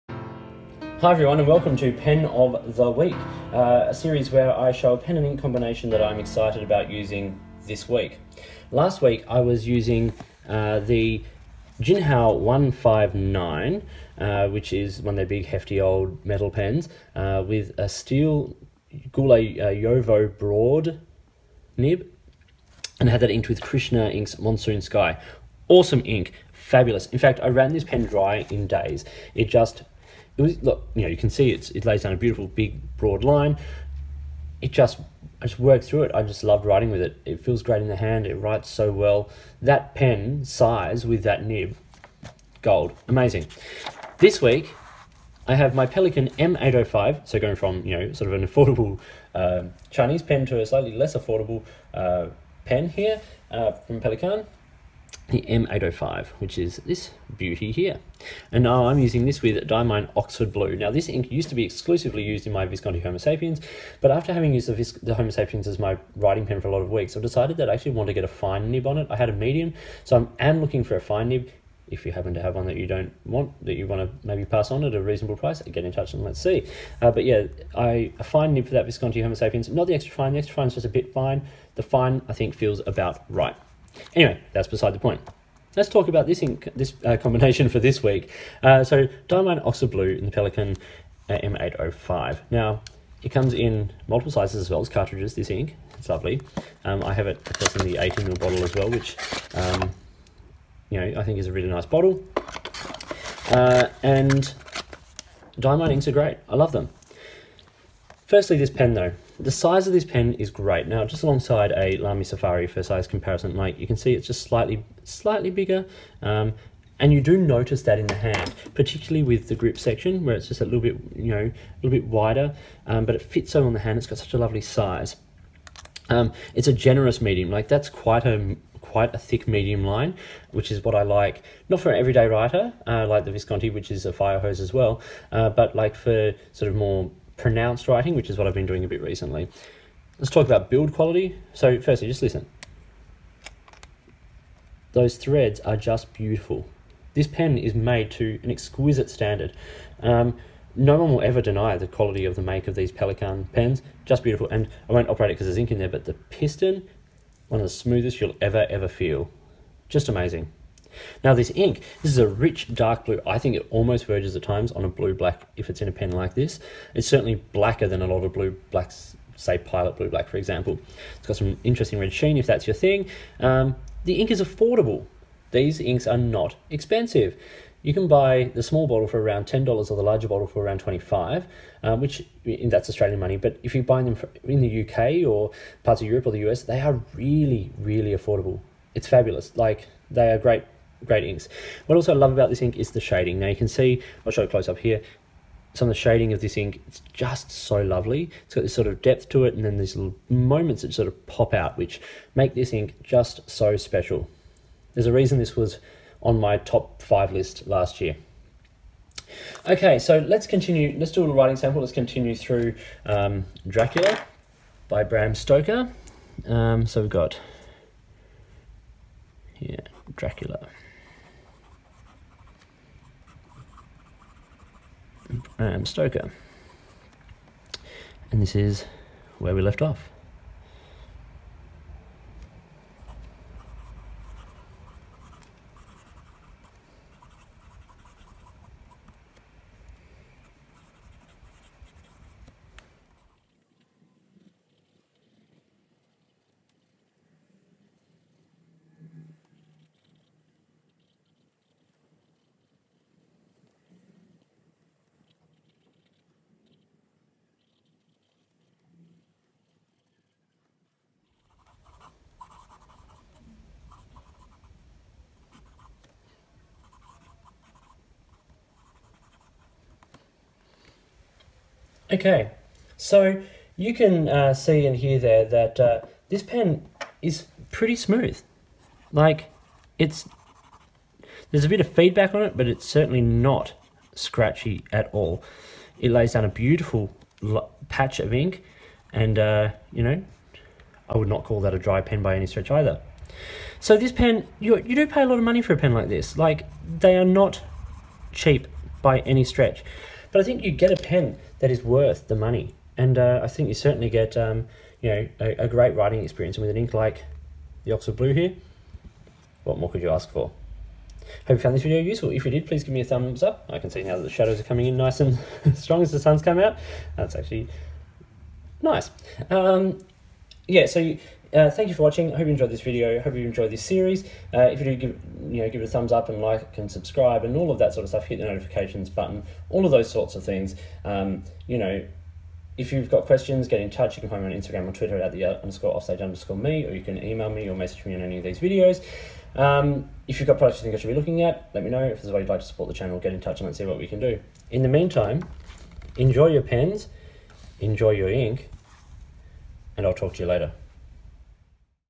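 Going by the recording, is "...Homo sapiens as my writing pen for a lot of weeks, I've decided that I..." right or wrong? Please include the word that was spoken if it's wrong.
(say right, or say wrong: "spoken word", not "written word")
right.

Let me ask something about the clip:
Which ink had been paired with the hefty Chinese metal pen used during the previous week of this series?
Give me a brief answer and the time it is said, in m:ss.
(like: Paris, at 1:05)
Krishna Inks Monsoon Sky, at 0:23.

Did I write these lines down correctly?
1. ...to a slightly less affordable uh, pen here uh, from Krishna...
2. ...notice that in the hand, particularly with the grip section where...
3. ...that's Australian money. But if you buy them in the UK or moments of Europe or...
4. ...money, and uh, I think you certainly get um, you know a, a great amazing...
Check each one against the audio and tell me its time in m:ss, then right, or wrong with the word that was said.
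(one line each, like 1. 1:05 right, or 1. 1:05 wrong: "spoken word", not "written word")
1. 0:50 wrong: "Pelikan", not "Krishna"
2. 1:57 right
3. 3:02 wrong: "parts", not "moments"
4. 5:02 wrong: "writing", not "amazing".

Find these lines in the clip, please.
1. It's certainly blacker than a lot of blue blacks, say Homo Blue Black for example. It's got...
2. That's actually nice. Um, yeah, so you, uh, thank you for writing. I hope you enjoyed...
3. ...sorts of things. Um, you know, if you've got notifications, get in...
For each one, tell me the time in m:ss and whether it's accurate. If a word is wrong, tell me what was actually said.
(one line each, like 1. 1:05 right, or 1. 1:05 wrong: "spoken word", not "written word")
1. 2:46 wrong: "Pilot", not "Homo"
2. 5:17 wrong: "watching", not "writing"
3. 5:30 wrong: "questions", not "notifications".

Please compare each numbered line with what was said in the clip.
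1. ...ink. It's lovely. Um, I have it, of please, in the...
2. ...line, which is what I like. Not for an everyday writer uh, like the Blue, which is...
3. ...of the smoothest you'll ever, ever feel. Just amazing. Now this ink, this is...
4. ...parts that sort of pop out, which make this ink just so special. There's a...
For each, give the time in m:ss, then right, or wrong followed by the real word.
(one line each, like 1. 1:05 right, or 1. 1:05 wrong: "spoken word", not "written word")
1. 1:35 wrong: "course", not "please"
2. 2:09 wrong: "Visconti", not "Blue"
3. 2:37 right
4. 3:20 wrong: "moments", not "parts".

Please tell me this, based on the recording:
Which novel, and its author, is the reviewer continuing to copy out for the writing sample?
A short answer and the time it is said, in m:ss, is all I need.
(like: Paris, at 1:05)
Dracula by Bram Stoker, at 3:33.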